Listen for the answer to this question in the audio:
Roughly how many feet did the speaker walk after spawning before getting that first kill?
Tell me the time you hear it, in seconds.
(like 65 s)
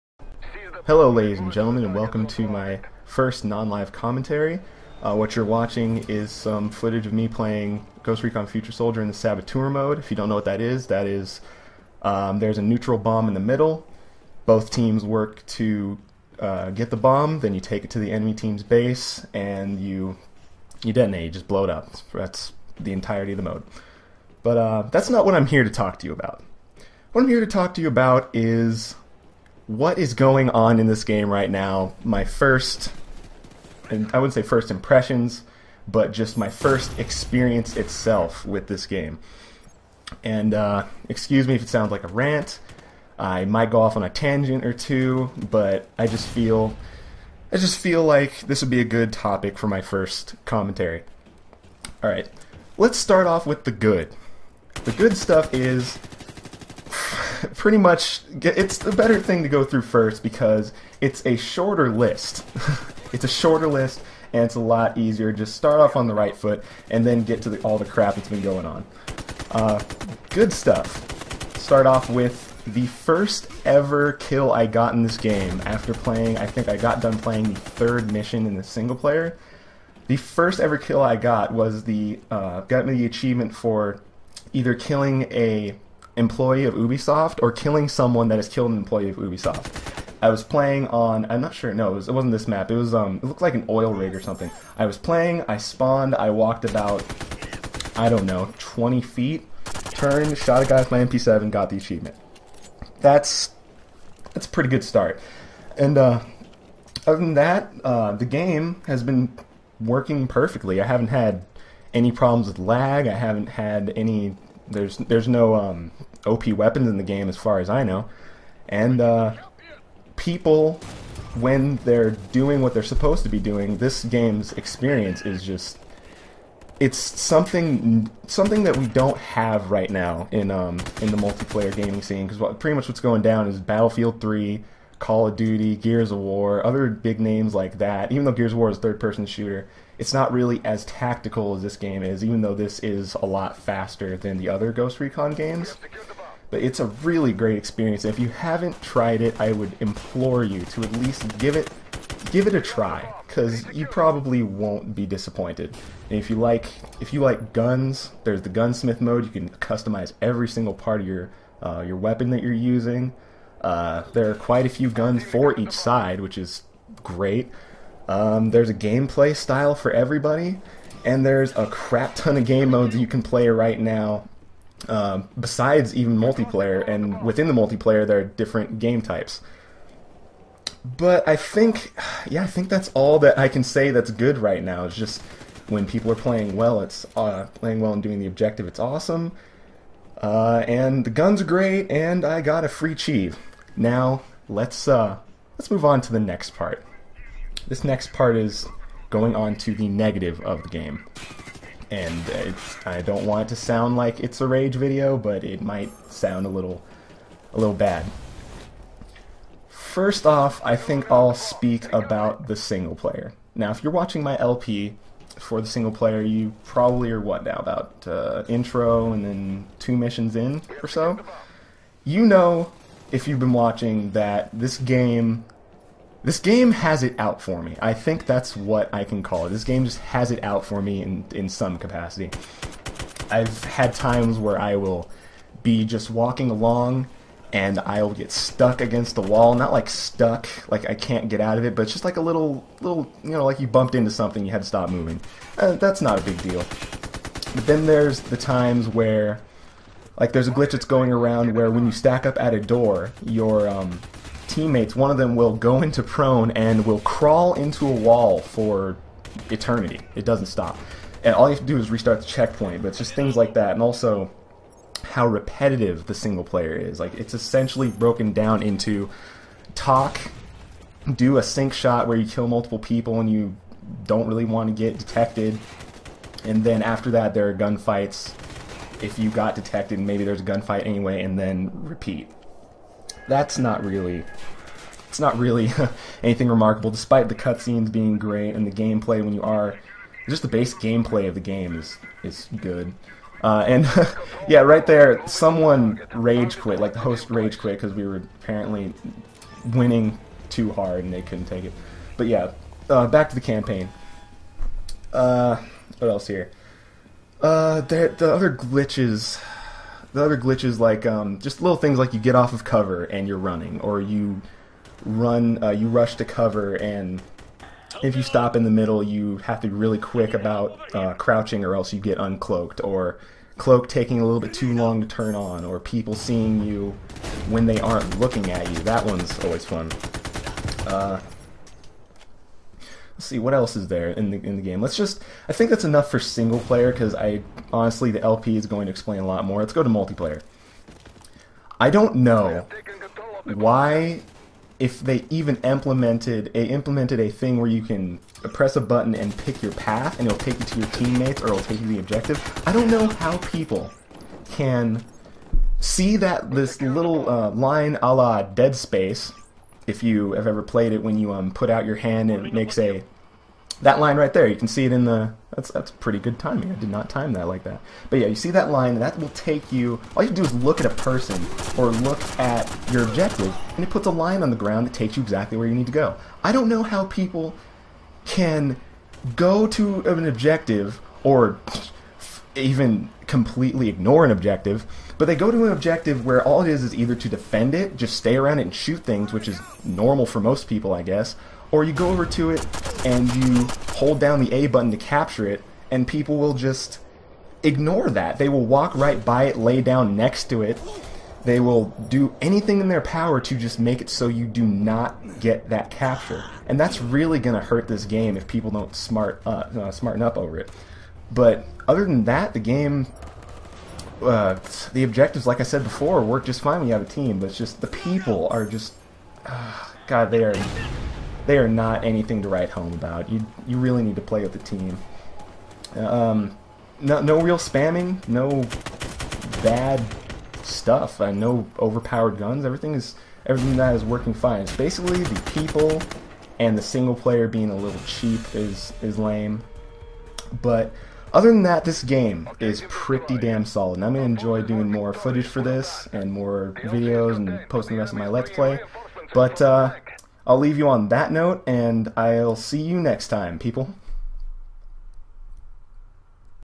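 98 s.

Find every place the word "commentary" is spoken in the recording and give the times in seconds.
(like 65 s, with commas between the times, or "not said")
3 s, 50 s.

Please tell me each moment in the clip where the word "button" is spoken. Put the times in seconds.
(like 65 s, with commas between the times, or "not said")
348 s, 394 s.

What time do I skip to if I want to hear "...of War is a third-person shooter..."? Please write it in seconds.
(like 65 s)
138 s.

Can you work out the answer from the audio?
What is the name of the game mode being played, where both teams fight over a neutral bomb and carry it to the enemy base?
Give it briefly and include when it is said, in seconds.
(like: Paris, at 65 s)
Saboteur, at 9 s.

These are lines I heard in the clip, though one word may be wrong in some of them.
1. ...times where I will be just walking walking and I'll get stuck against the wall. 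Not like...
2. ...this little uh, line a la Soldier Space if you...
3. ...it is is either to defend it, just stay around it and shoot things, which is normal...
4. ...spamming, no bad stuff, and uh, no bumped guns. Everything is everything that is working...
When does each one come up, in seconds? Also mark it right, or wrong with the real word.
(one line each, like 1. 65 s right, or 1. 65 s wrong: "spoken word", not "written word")
1. 233 s wrong: "along", not "walking"
2. 356 s wrong: "Dead", not "Soldier"
3. 386 s right
4. 427 s wrong: "overpowered", not "bumped".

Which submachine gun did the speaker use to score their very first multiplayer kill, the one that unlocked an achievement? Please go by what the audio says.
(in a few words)
MP7.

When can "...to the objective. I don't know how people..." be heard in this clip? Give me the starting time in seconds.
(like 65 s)
351 s.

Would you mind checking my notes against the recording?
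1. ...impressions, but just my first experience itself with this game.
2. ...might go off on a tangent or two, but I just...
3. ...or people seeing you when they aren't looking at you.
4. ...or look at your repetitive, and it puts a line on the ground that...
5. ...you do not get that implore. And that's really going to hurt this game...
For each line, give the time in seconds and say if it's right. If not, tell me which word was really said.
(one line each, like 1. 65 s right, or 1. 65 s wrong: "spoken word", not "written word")
1. 34 s right
2. 43 s right
3. 325 s right
4. 371 s wrong: "objective", not "repetitive"
5. 404 s wrong: "capture", not "implore".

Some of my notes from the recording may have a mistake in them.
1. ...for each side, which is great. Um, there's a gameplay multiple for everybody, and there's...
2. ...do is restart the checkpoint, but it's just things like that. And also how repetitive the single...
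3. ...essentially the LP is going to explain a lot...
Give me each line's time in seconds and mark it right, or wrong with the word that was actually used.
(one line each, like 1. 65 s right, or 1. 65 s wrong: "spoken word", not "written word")
1. 165 s wrong: "style", not "multiple"
2. 261 s right
3. 337 s wrong: "honestly", not "essentially".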